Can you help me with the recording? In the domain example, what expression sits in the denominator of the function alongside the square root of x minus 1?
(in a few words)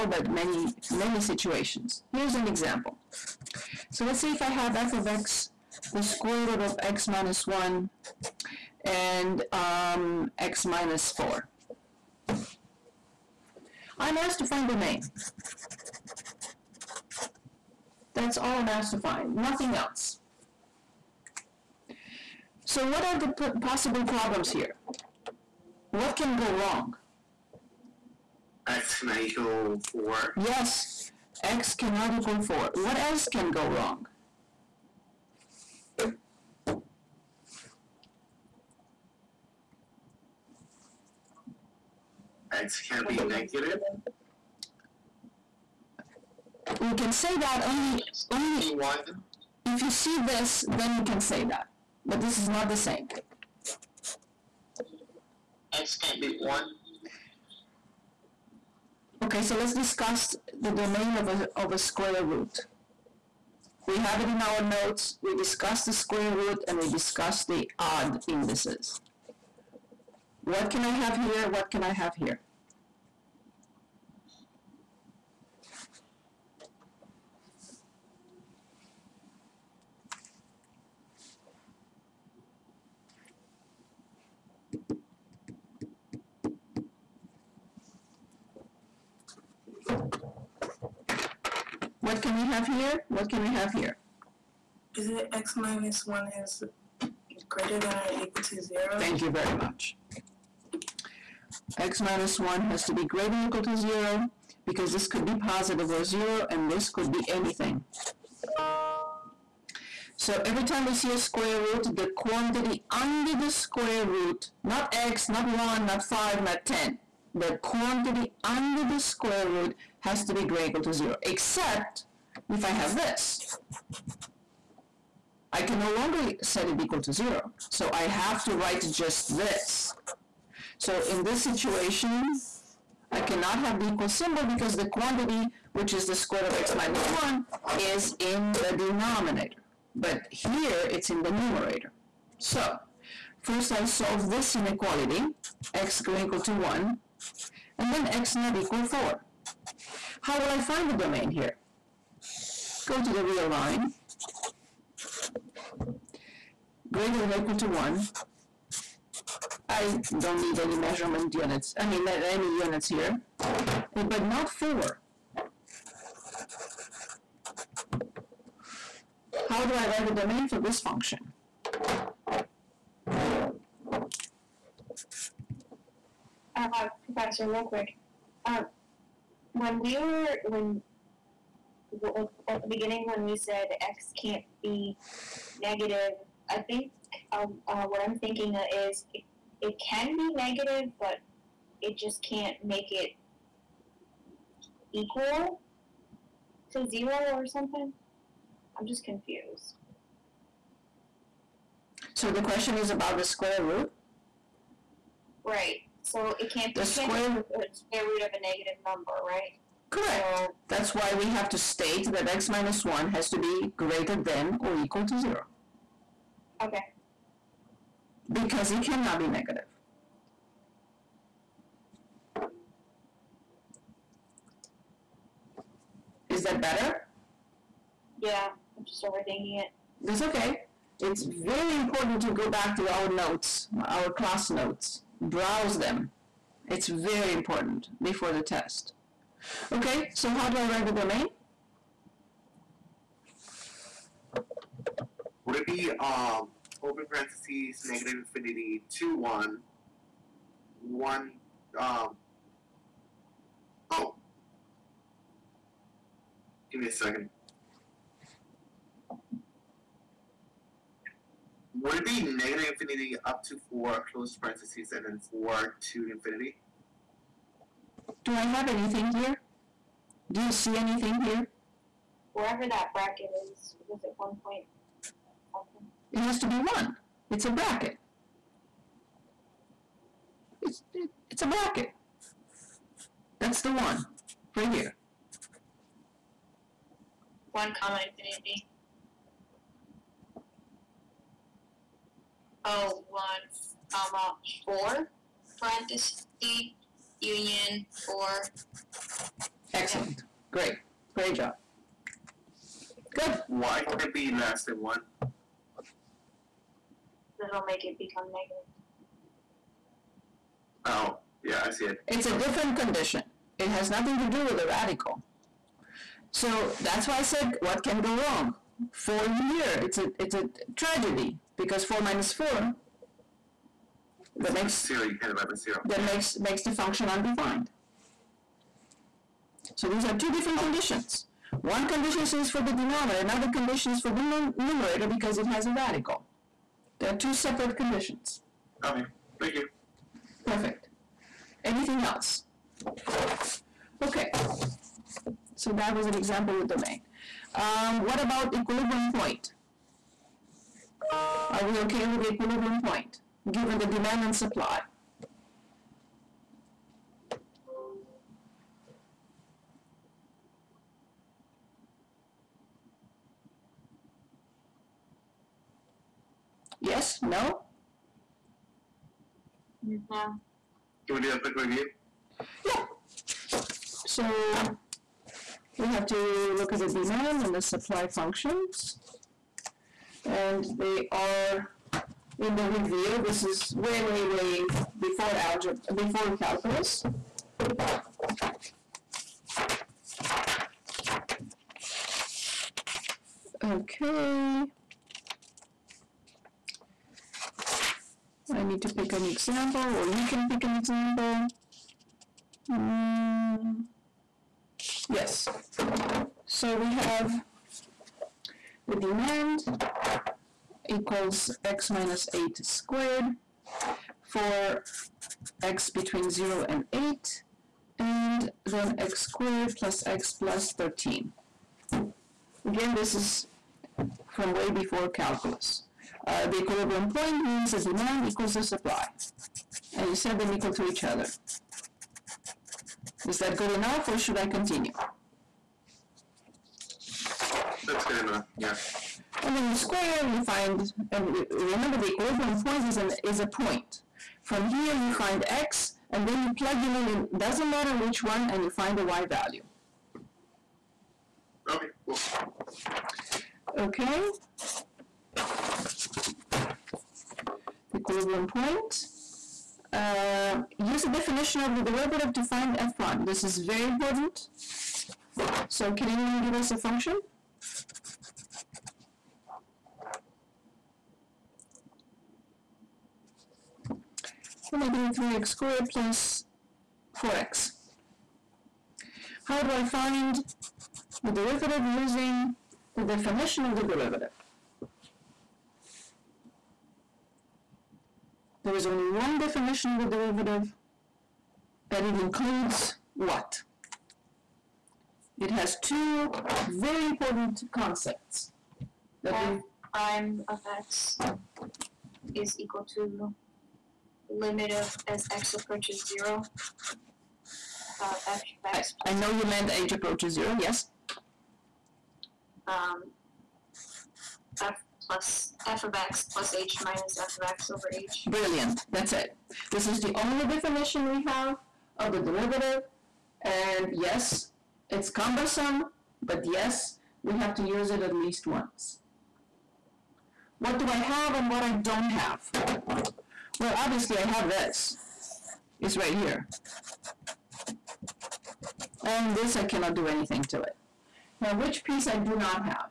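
x minus 4.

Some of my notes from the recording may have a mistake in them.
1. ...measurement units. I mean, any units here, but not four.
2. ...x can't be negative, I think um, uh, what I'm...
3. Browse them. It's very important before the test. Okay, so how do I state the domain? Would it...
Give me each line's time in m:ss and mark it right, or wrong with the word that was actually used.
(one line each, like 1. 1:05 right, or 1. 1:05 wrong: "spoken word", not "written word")
1. 2:40 right
2. 3:03 right
3. 3:55 wrong: "write", not "state".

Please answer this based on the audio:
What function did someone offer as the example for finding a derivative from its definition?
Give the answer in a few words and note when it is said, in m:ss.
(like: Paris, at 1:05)
negative 3x squared plus 4x, at 7:54.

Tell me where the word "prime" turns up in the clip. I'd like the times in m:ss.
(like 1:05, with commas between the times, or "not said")
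7:42, 8:19.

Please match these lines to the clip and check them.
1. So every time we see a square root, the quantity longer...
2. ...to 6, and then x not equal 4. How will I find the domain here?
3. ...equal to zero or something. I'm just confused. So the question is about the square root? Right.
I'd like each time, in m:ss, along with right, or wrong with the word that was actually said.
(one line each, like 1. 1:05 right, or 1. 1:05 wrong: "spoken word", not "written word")
1. 1:50 wrong: "under", not "longer"
2. 2:26 wrong: "1", not "6"
3. 3:14 right.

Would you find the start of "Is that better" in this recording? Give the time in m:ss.
3:46.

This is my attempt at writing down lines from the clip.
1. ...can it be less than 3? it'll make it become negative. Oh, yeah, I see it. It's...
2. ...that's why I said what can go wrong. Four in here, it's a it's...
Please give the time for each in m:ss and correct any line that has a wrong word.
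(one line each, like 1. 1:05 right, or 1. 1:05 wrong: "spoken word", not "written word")
1. 5:03 wrong: "1", not "3"
2. 5:16 right.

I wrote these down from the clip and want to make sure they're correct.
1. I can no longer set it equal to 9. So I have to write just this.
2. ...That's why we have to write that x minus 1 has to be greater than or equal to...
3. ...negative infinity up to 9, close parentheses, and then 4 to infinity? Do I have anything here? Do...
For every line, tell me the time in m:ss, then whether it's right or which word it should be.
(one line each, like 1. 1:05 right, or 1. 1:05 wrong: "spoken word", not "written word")
1. 2:05 wrong: "0", not "9"
2. 3:30 wrong: "state", not "write"
3. 4:22 wrong: "4", not "9".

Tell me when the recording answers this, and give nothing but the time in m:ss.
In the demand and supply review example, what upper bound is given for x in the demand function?
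6:54.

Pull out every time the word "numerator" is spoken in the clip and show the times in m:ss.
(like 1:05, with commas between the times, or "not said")
2:21, 5:34.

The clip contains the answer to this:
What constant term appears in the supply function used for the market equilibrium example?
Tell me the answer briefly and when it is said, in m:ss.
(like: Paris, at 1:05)
13, at 7:00.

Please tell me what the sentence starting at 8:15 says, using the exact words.
It has two very important concepts.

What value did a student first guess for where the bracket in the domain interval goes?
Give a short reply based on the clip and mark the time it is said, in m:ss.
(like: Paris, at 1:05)
1.5, at 4:33.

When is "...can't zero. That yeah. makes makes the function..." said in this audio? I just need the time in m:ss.
5:25.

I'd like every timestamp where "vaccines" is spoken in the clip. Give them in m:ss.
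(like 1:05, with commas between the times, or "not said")
not said.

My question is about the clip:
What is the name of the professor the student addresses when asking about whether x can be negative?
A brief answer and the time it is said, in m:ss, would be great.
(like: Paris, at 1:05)
Professor Linkwick, at 2:57.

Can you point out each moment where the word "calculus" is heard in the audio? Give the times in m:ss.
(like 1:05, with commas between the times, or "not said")
6:26, 7:05.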